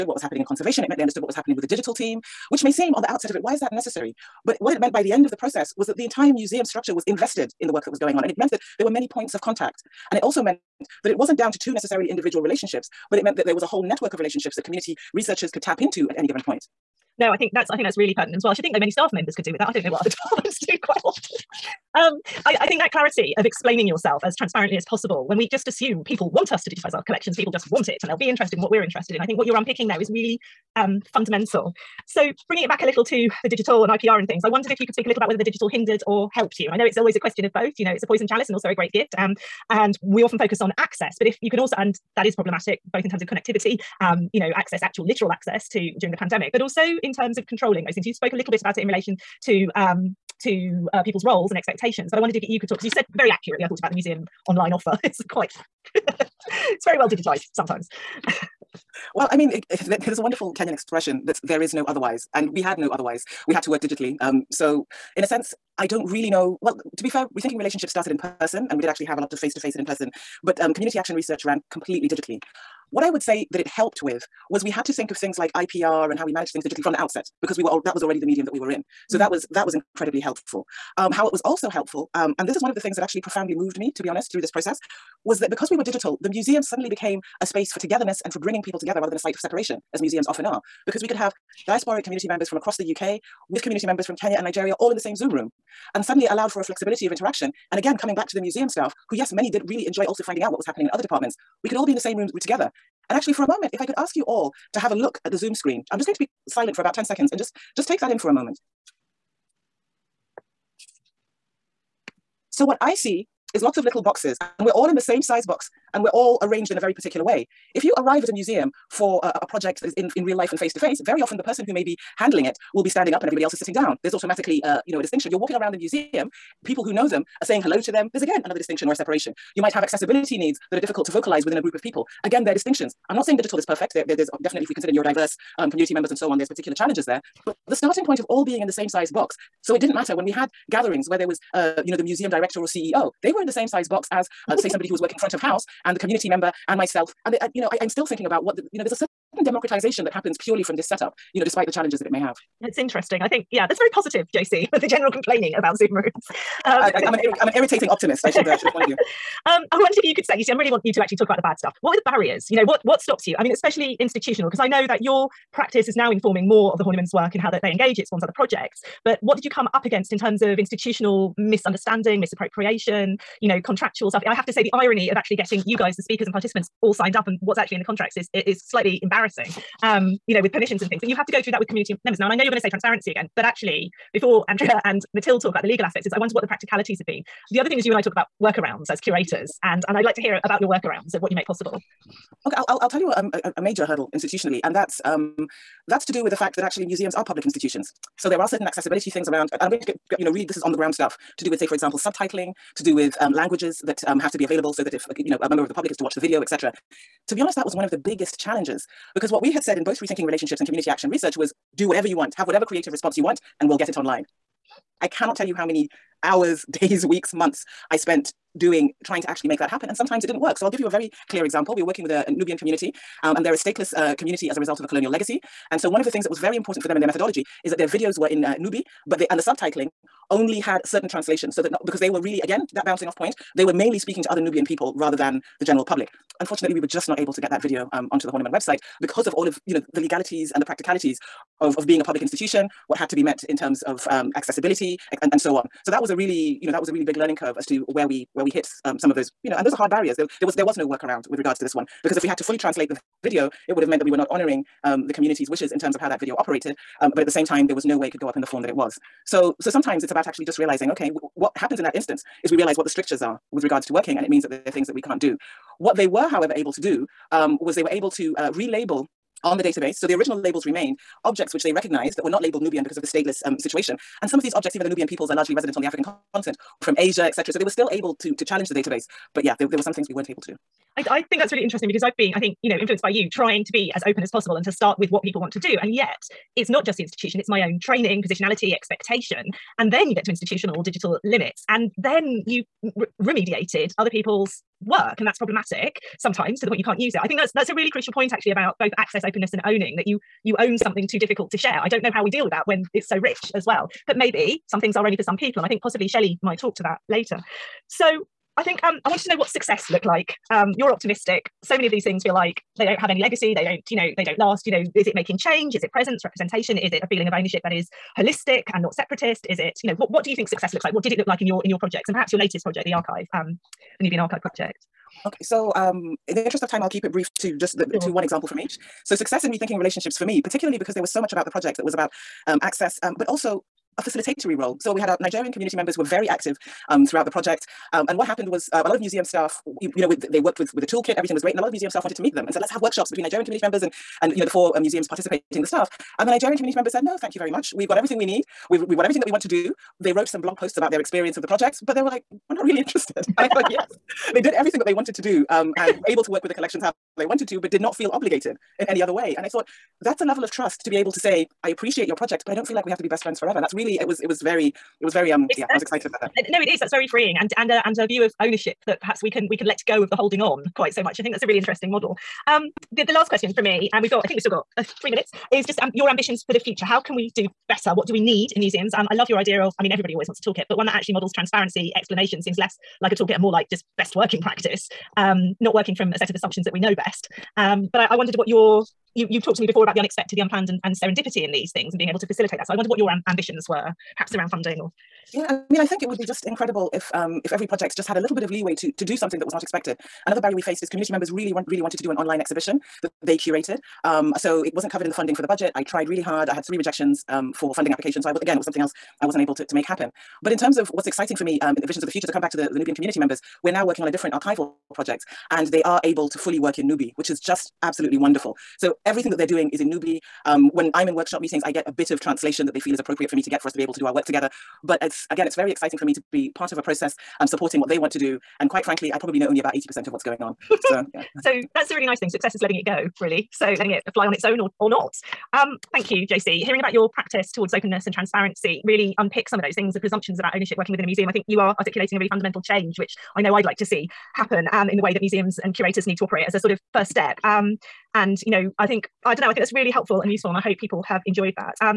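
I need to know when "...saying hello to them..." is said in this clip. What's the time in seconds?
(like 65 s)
127 s.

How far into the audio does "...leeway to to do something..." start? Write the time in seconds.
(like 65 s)
398 s.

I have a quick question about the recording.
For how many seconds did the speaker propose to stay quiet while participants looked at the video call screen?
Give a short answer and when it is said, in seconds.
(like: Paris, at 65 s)
10, at 106 s.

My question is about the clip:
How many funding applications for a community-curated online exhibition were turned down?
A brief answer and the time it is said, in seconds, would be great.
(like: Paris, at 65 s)
3, at 406 s.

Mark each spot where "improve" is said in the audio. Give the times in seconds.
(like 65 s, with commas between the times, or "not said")
not said.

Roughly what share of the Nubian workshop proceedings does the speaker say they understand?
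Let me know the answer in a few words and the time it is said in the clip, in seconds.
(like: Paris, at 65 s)
80%, at 429 s.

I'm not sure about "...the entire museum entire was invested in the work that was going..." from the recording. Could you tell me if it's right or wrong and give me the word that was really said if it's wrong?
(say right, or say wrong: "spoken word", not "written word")
wrong: "structure", not "entire".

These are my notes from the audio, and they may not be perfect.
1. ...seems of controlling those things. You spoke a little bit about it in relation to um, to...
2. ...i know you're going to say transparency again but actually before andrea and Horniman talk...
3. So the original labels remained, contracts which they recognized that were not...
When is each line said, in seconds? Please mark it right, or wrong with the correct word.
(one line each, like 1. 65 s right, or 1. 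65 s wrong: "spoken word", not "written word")
1. 47 s wrong: "terms", not "seems"
2. 182 s wrong: "Mathilde", not "Horniman"
3. 269 s wrong: "objects", not "contracts".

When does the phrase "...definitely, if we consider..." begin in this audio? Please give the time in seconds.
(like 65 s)
134 s.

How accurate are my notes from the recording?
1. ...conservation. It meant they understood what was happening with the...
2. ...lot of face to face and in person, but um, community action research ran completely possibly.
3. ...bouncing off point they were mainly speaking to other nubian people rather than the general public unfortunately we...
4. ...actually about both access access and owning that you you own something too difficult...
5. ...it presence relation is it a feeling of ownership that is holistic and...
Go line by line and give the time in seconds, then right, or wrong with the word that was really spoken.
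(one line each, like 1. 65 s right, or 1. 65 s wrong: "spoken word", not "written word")
1. 0 s right
2. 69 s wrong: "digitally", not "possibly"
3. 232 s right
4. 298 s wrong: "openness", not "access"
5. 315 s wrong: "representation", not "relation".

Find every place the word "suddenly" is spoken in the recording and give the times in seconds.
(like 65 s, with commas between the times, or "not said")
86 s, 96 s.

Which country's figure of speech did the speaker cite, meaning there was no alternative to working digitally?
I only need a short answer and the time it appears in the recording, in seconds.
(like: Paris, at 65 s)
Kenyan, at 60 s.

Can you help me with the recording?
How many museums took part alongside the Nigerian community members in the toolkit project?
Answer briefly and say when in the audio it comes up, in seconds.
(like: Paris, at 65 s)
4, at 344 s.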